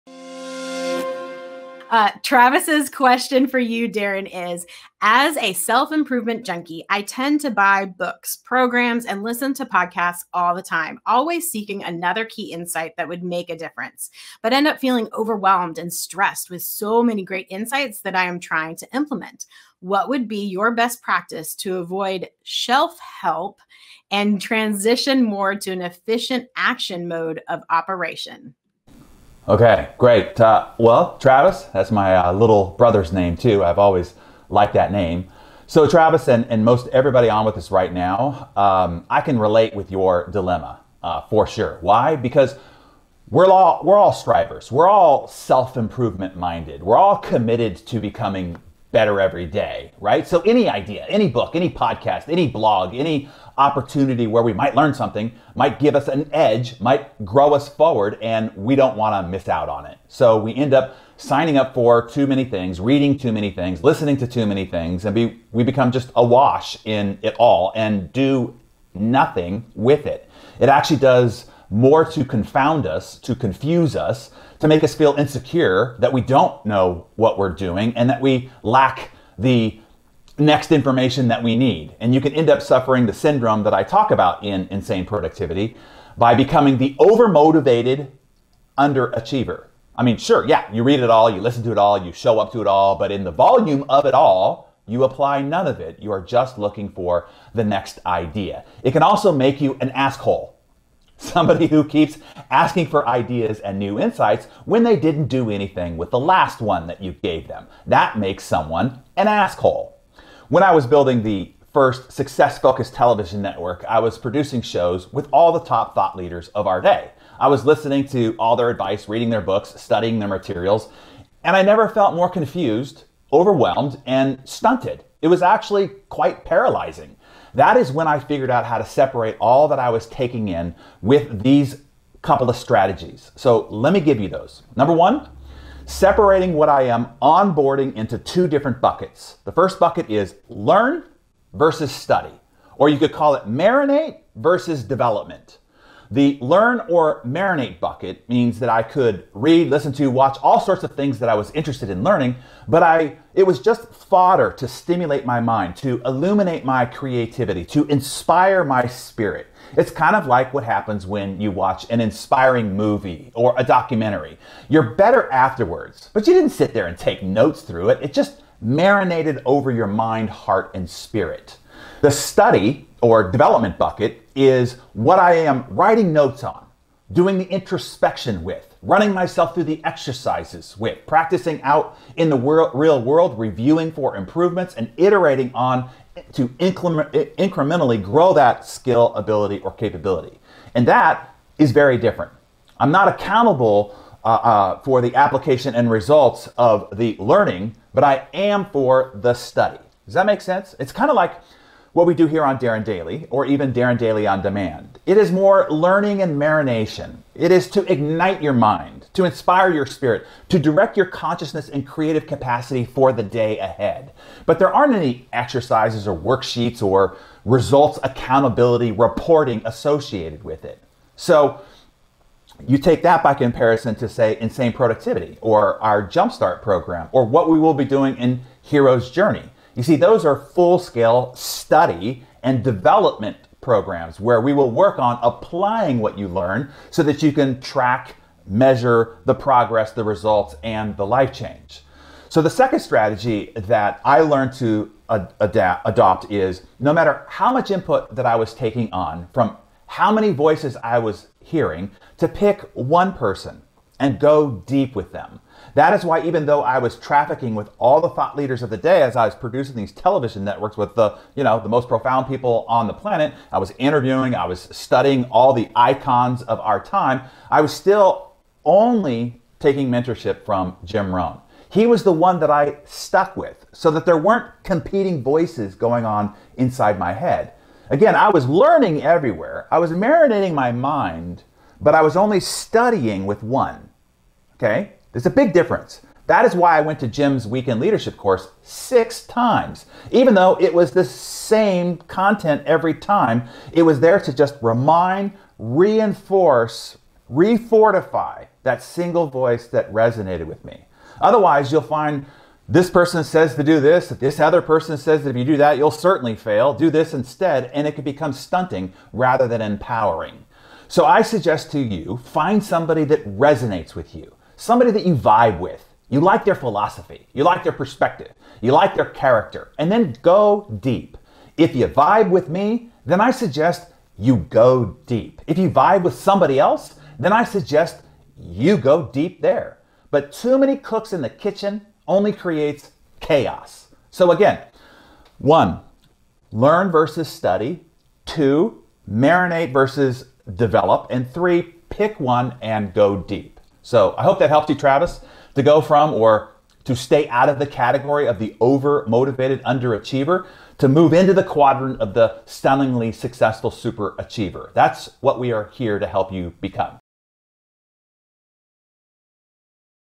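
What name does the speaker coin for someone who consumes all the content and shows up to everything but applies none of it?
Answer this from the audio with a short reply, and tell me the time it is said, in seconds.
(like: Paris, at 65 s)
overmotivated underachiever, at 86 s.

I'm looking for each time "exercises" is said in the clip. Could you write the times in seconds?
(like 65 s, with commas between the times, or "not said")
179 s, 215 s.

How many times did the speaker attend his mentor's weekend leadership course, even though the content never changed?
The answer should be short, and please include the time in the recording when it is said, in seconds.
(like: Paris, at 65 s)
6, at 288 s.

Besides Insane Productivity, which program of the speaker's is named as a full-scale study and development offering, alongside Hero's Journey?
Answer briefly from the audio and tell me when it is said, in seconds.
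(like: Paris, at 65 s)
Jumpstart, at 226 s.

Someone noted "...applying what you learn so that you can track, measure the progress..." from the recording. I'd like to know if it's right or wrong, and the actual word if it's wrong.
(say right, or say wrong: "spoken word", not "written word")
right.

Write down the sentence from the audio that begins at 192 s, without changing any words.
I'm not accountable uh, uh, for the application and results of the learning, but I am for the study.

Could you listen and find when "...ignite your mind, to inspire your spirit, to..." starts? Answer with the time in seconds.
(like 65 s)
207 s.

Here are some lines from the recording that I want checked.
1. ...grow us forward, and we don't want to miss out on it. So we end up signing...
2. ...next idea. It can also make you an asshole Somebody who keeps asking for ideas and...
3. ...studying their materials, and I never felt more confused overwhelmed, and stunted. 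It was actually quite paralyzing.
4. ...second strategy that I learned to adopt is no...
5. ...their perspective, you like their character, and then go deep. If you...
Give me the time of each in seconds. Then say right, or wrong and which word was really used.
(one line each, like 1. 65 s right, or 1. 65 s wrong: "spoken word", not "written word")
1. 57 s right
2. 97 s right
3. 119 s right
4. 242 s right
5. 317 s right.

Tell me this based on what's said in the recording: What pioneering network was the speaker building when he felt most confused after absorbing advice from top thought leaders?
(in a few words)
success focused television network.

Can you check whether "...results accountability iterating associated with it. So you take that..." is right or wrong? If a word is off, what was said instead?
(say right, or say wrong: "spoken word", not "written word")
wrong: "reporting", not "iterating".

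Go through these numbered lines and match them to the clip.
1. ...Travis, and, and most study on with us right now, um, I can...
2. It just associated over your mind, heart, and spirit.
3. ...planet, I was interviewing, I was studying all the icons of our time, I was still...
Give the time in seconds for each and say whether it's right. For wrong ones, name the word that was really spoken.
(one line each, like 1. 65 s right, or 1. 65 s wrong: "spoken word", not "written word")
1. 35 s wrong: "everybody", not "study"
2. 168 s wrong: "marinated", not "associated"
3. 262 s right.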